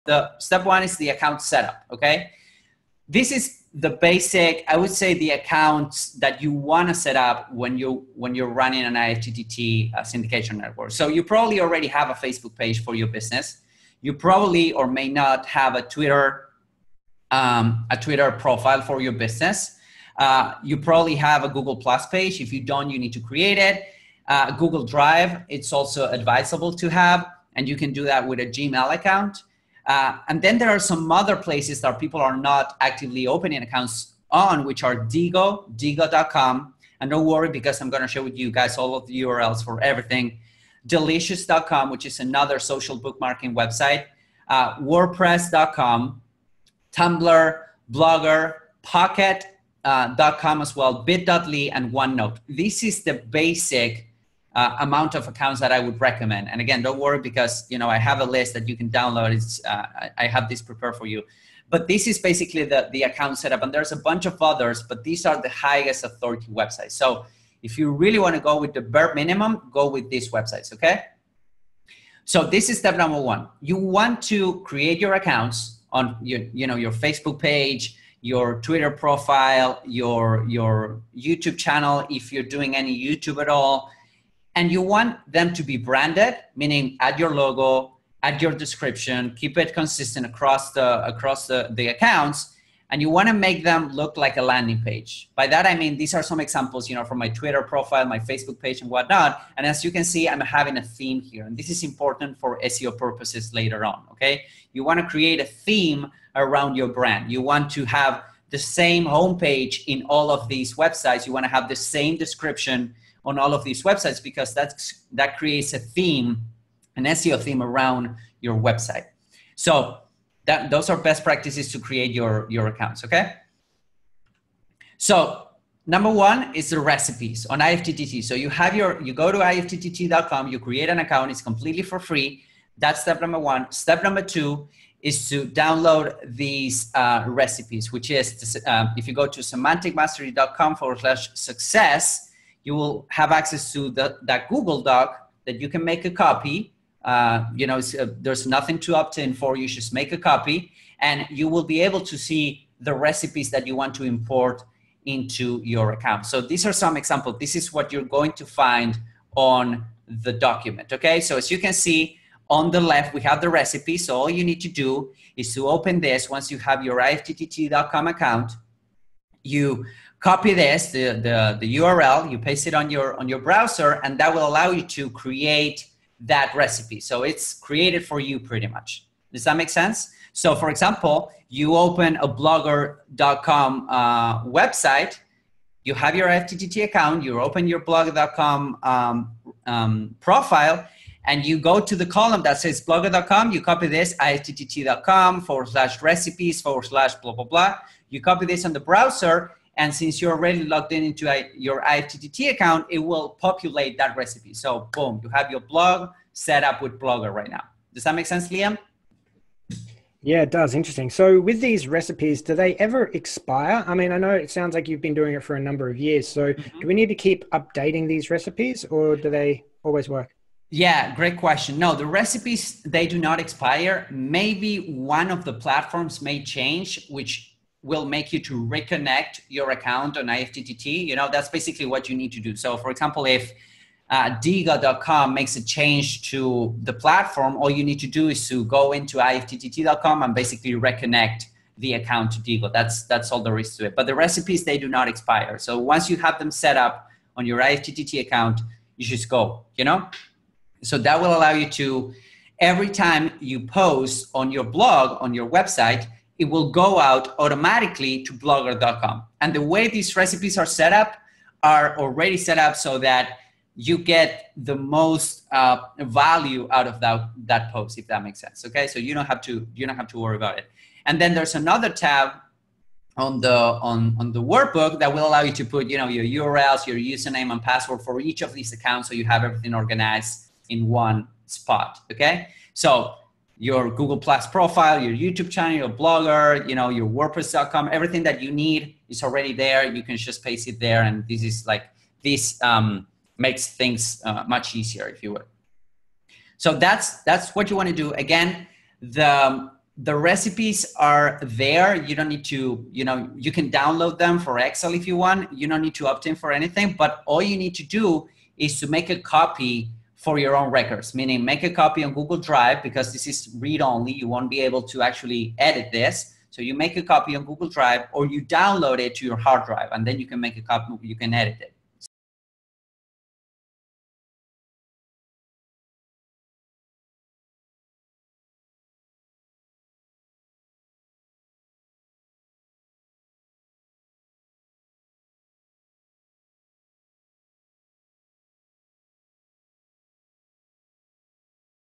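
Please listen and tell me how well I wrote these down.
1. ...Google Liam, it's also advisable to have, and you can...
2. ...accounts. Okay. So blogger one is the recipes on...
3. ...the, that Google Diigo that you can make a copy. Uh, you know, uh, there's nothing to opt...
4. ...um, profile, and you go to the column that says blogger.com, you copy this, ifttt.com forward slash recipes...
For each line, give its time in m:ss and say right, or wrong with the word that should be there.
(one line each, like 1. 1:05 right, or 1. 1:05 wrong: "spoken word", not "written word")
1. 0:24 wrong: "Drive", not "Liam"
2. 2:02 wrong: "number", not "blogger"
3. 2:23 wrong: "Doc", not "Diigo"
4. 3:09 right.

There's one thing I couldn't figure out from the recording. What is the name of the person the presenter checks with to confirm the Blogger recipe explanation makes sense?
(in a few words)
Liam.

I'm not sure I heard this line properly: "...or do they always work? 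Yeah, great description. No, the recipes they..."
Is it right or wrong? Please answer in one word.
wrong.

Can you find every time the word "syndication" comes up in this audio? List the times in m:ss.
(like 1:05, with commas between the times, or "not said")
0:10.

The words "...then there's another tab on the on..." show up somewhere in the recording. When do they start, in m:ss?
4:31.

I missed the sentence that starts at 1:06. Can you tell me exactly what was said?
So if you really want to go with the bare minimum, go with these websites, okay?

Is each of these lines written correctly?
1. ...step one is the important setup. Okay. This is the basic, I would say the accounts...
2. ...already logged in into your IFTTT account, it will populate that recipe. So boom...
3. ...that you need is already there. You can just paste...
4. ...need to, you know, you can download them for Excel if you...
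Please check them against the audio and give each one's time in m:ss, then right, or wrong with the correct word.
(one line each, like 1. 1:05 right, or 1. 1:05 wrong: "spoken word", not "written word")
1. 0:00 wrong: "account", not "important"
2. 3:20 right
3. 4:48 right
4. 5:02 right.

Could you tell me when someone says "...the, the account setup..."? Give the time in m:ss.
1:02.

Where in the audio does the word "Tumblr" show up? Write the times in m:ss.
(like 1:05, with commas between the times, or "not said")
0:46.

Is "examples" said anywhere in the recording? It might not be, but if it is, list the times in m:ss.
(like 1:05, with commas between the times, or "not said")
1:36, 2:36, 3:00, 3:52.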